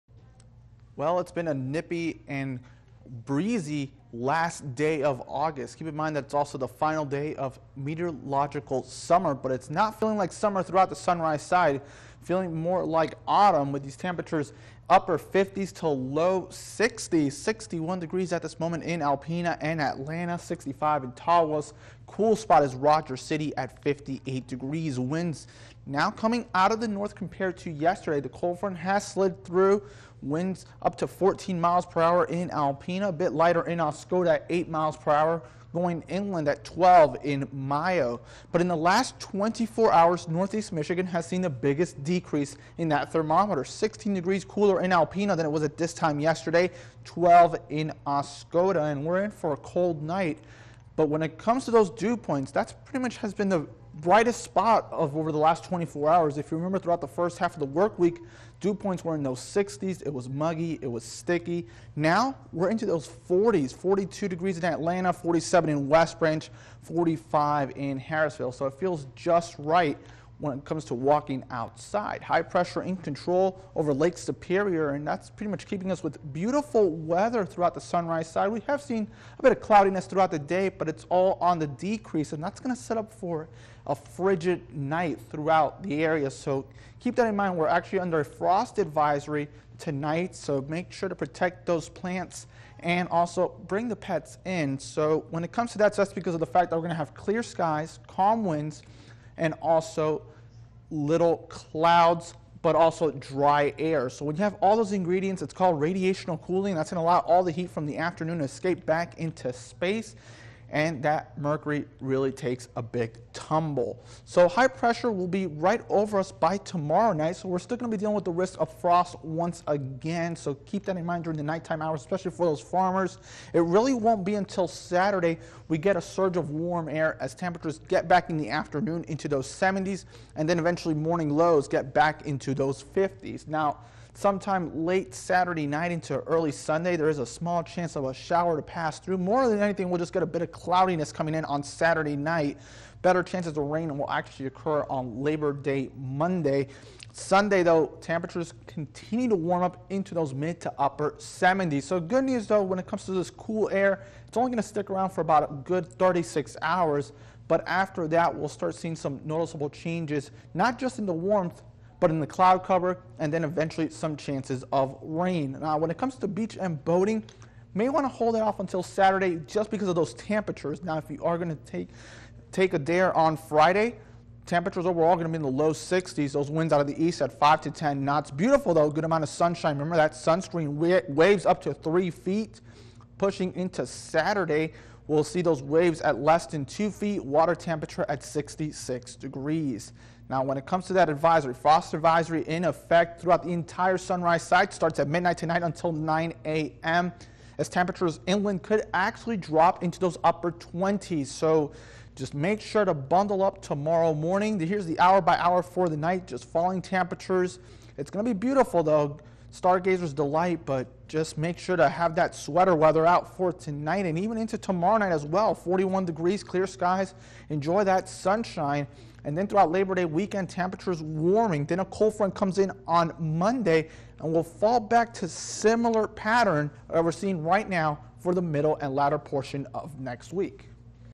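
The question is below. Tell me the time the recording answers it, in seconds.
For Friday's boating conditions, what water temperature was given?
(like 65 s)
188 s.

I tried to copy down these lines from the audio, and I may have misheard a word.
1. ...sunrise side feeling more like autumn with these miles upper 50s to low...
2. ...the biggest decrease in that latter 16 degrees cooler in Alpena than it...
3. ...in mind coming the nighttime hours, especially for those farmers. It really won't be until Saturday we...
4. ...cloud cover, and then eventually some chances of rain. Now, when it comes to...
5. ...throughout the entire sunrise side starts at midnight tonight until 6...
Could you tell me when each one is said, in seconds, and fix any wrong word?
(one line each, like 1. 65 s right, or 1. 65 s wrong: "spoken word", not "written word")
1. 10 s wrong: "temperatures", not "miles"
2. 41 s wrong: "thermometer", not "latter"
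3. 120 s wrong: "during", not "coming"
4. 162 s right
5. 193 s wrong: "9", not "6".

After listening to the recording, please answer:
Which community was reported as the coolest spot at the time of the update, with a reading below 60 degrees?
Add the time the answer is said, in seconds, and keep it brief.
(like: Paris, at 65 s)
Rogers City, at 22 s.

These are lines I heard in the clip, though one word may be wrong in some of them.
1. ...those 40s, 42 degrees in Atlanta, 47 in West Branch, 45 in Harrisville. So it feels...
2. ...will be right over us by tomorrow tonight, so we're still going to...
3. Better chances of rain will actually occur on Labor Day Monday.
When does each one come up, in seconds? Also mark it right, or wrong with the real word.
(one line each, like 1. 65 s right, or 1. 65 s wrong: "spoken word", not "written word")
1. 62 s right
2. 115 s wrong: "night", not "tonight"
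3. 143 s right.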